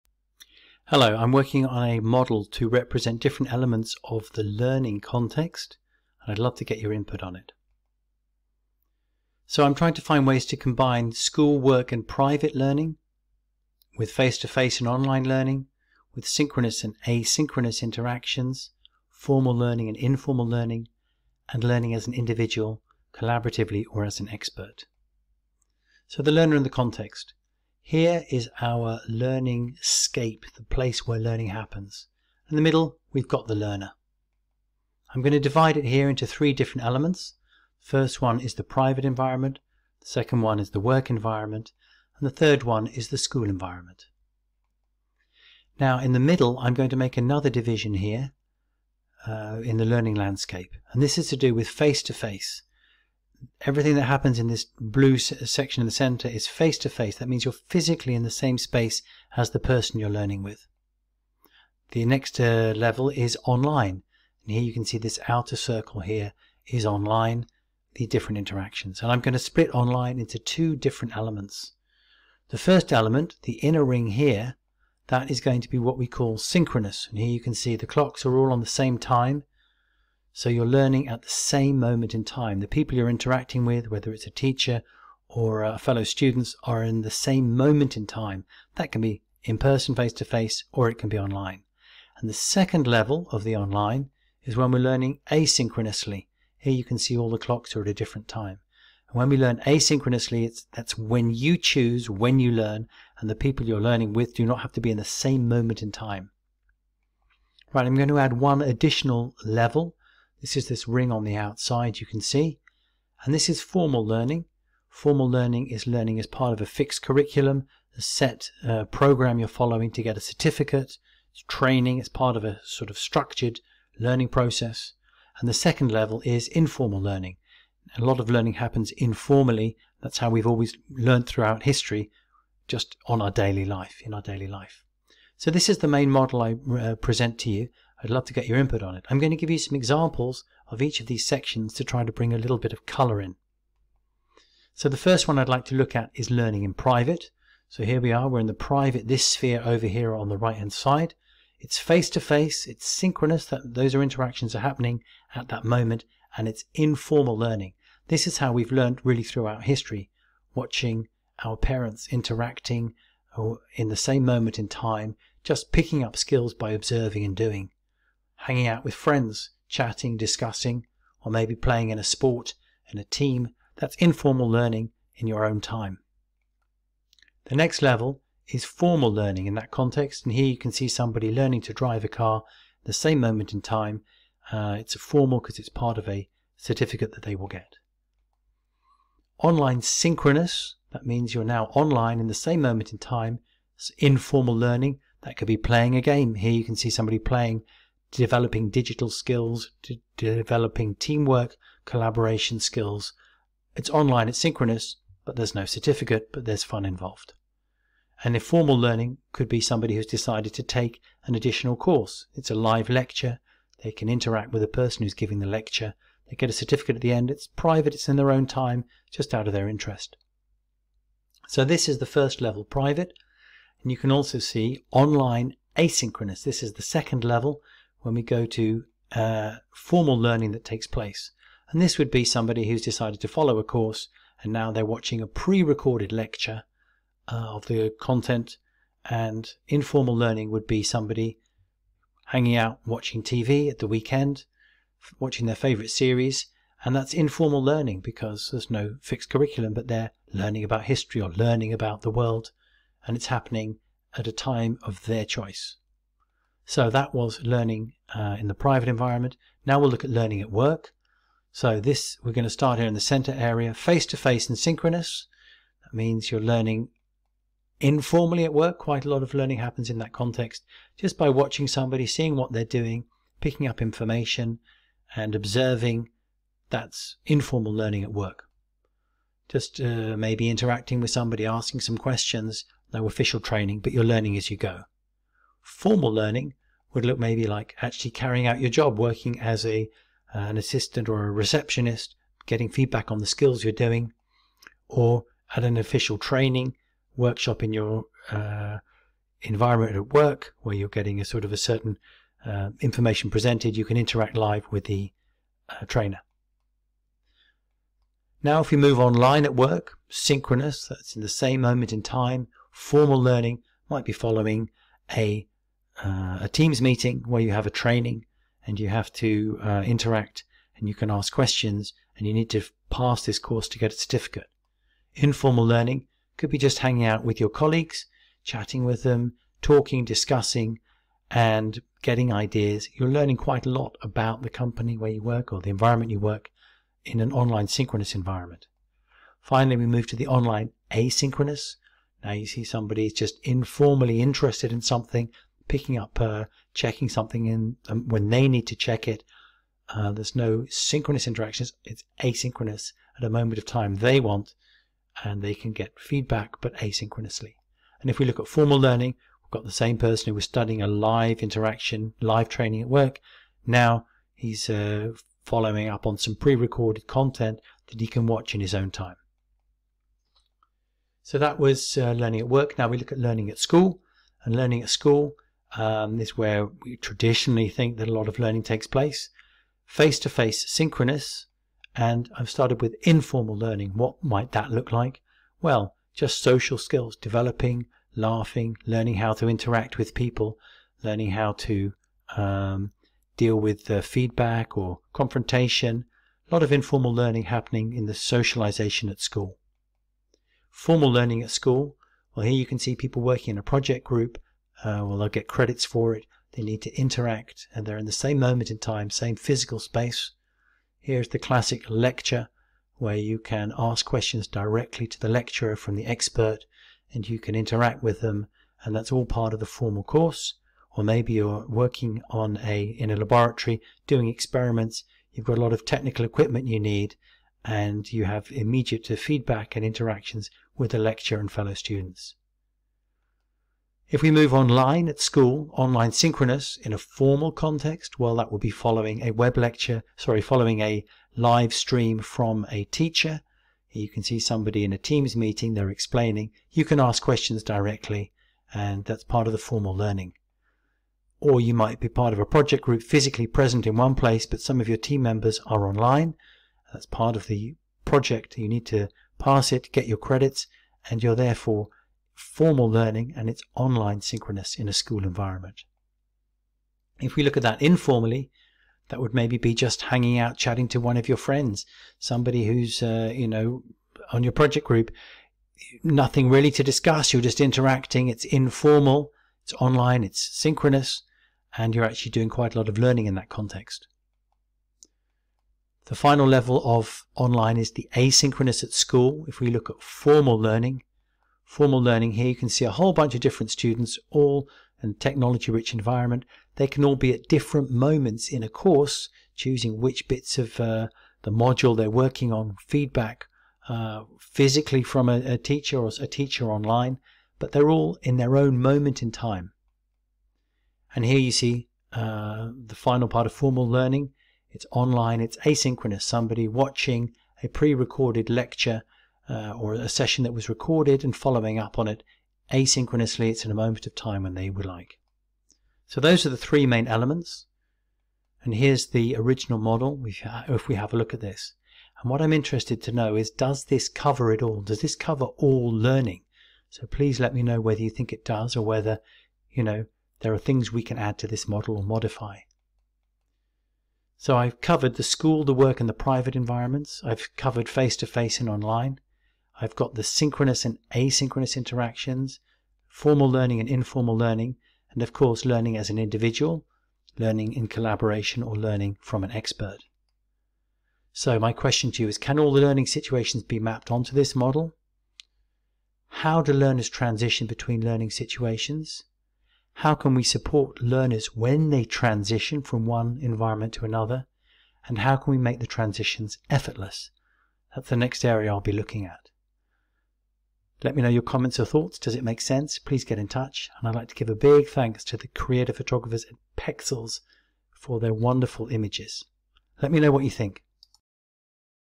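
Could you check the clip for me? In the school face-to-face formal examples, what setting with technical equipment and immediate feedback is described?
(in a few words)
laboratory.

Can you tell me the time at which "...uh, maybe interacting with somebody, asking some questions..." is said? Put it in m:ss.
4:39.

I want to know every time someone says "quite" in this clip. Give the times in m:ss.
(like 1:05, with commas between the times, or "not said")
4:28, 5:33, 8:02.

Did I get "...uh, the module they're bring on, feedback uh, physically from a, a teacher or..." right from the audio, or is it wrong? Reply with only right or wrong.
wrong.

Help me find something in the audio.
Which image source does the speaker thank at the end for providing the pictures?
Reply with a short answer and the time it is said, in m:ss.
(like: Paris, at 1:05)
Pexels, at 9:46.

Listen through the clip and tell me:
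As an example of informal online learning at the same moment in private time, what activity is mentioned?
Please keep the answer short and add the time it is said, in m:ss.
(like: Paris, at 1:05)
playing a game, at 3:15.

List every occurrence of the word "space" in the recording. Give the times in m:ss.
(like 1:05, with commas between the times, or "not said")
0:58, 6:49.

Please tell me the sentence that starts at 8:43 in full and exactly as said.
It's in a moment of time when they would like.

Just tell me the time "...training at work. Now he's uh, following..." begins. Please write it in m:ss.
6:02.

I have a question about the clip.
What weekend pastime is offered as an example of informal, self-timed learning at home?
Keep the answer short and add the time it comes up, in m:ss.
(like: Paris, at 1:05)
watching TV, at 4:02.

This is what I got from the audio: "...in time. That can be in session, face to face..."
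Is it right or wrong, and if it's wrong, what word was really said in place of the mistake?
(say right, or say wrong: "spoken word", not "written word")
wrong: "person", not "session".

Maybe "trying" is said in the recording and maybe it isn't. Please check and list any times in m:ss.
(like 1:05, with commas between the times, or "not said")
0:09.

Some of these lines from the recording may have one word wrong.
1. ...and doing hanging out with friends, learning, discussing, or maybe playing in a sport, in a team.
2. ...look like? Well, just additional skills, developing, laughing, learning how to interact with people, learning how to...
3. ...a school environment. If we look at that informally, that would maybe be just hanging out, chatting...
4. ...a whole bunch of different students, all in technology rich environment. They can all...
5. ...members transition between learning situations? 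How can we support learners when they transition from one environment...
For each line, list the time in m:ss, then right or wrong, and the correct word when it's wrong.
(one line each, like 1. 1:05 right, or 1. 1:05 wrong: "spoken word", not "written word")
1. 2:47 wrong: "chatting", not "learning"
2. 6:24 wrong: "social", not "additional"
3. 7:44 right
4. 8:12 right
5. 9:26 wrong: "learners", not "members".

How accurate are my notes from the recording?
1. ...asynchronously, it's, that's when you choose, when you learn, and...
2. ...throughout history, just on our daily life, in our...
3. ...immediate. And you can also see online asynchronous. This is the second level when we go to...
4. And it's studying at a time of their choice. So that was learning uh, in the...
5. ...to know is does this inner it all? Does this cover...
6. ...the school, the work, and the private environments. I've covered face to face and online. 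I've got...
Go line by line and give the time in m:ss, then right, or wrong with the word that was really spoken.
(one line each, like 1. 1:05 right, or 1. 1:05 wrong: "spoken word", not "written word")
1. 1:39 right
2. 2:11 right
3. 3:42 wrong: "private", not "immediate"
4. 4:13 wrong: "happening", not "studying"
5. 8:53 wrong: "cover", not "inner"
6. 9:05 right.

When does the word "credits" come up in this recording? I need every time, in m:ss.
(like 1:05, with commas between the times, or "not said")
6:45, 7:40.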